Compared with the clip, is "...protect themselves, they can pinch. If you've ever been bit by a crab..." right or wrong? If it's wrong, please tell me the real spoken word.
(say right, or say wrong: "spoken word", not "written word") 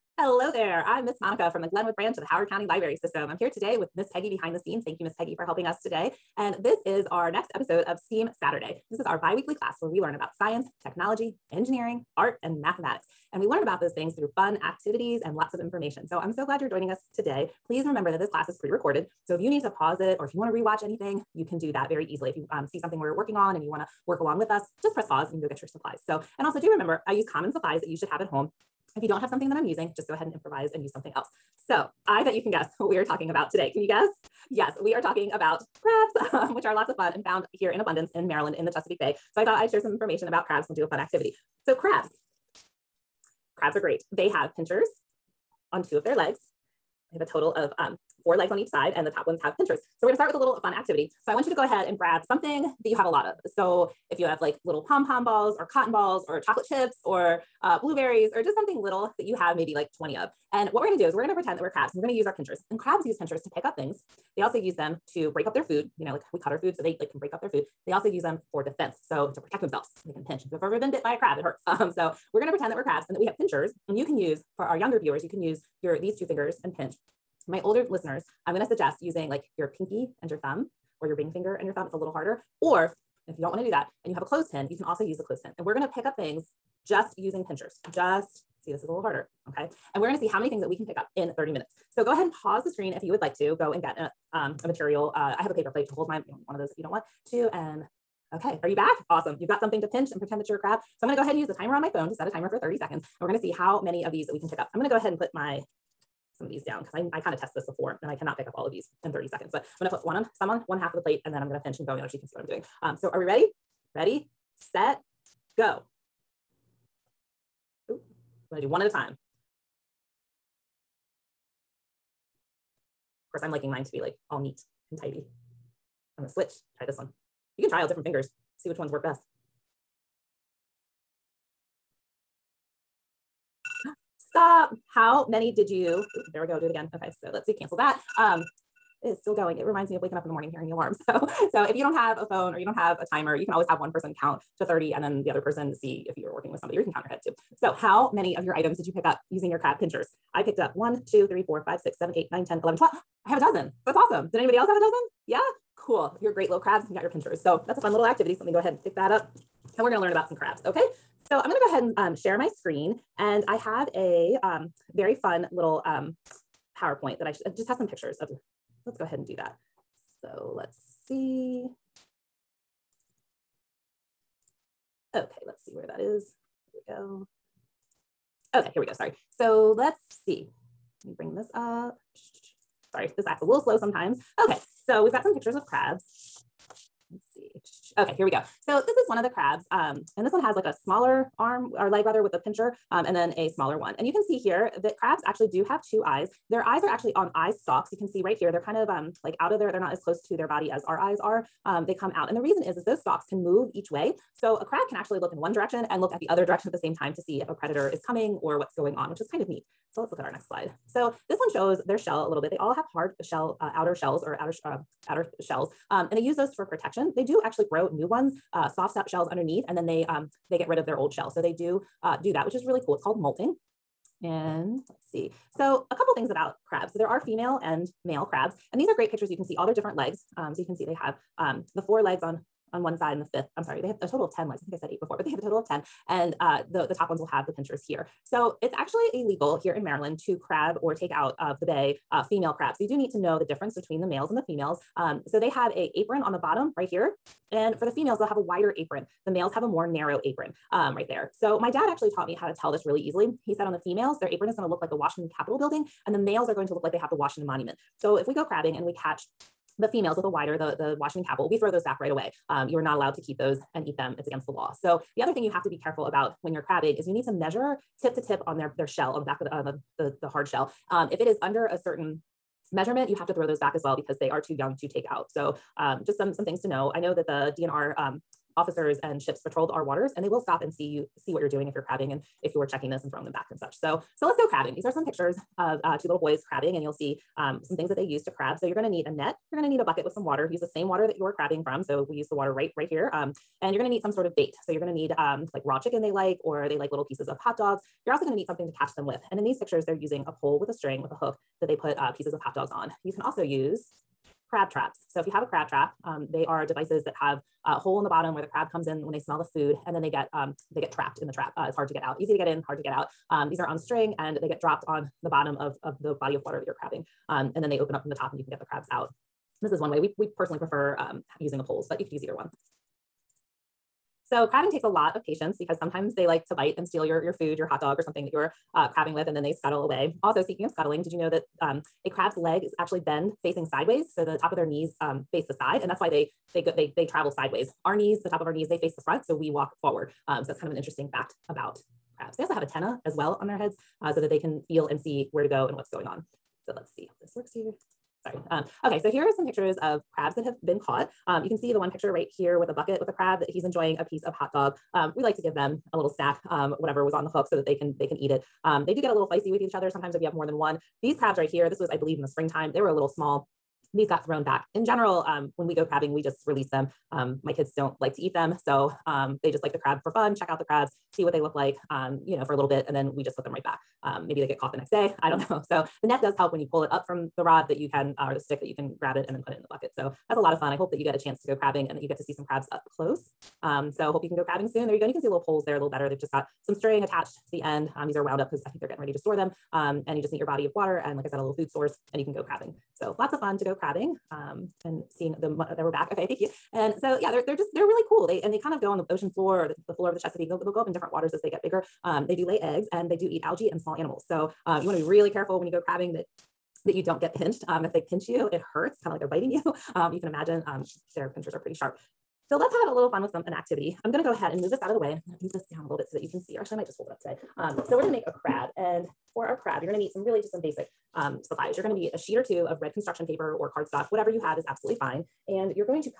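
right.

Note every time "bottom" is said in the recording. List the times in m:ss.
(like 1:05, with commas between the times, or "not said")
4:06, 5:08, 5:15.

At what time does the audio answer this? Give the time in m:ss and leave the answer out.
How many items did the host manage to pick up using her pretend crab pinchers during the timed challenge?
2:32.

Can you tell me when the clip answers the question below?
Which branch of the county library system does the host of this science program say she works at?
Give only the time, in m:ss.
0:01.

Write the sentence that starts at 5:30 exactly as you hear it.
Also, speaking of scuttling, did you know that um, a crab's legs actually bend facing sideways?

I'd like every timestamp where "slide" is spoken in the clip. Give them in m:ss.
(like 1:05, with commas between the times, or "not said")
3:30.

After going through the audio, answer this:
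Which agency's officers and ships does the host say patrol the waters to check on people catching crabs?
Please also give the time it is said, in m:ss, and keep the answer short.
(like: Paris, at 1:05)
DNR, at 4:37.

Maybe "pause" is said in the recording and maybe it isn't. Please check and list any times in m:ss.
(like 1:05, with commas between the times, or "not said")
0:19, 0:25, 1:32.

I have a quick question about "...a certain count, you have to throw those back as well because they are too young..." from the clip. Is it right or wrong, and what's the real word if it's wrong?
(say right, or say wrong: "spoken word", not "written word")
wrong: "measurement", not "count".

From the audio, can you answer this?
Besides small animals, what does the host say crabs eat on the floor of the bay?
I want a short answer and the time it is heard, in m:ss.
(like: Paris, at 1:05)
Algae, at 6:43.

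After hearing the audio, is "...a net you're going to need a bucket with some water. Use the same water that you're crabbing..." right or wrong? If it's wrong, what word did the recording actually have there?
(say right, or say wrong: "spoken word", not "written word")
right.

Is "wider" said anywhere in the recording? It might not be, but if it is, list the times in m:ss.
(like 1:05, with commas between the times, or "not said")
4:08, 4:20.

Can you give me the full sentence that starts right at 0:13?
And we learn about those things through fun activities and lots of information.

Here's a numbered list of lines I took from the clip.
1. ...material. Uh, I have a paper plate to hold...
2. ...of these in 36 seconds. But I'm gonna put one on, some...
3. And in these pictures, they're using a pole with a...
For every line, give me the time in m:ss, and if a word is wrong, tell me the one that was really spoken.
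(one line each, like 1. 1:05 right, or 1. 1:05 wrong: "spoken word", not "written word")
1. 1:34 right
2. 1:48 wrong: "30", not "36"
3. 4:59 right.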